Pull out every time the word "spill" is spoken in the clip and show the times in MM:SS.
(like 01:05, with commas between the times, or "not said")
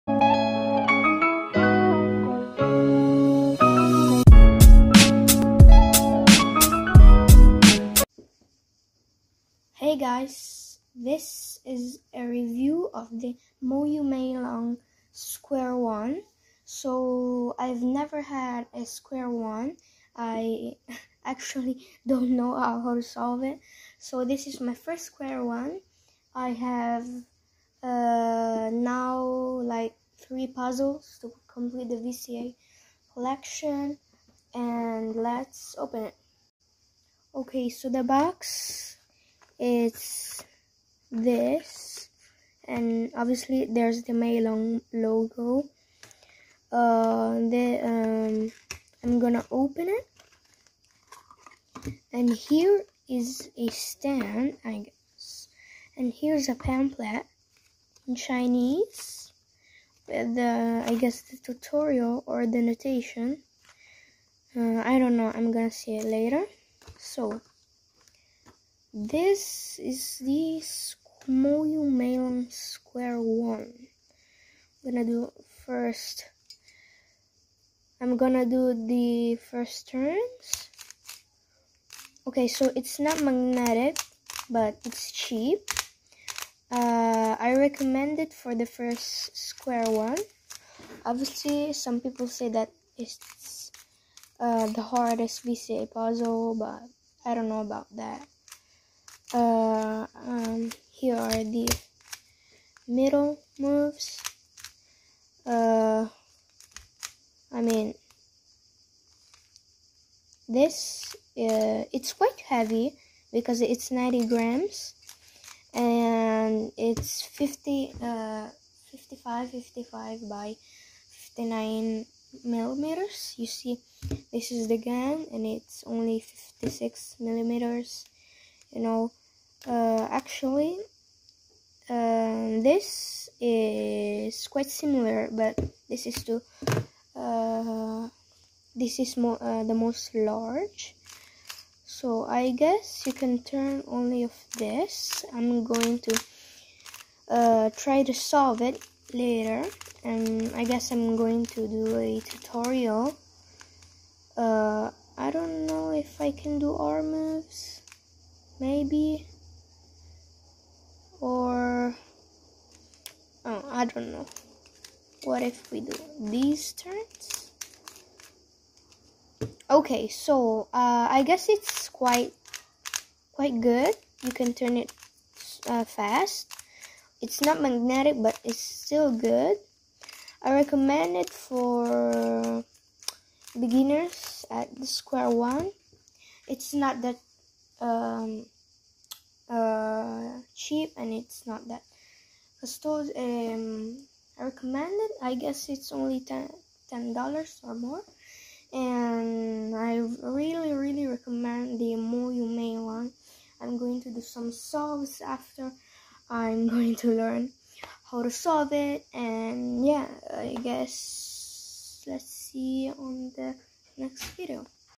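not said.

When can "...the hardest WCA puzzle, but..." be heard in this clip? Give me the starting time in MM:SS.
01:34.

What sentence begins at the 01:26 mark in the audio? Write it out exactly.
Uh, I recommend it for the first square one.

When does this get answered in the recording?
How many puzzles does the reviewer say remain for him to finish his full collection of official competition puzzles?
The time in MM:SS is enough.
00:30.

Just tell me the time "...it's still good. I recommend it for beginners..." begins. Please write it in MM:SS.
02:58.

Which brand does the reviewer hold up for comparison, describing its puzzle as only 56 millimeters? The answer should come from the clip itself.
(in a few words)
GAN.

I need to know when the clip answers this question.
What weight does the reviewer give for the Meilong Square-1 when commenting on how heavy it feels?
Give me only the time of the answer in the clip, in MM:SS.
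01:53.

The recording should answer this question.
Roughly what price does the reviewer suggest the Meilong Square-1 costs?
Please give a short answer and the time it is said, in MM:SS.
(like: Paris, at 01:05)
$10, at 03:16.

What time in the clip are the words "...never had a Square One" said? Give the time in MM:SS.
00:17.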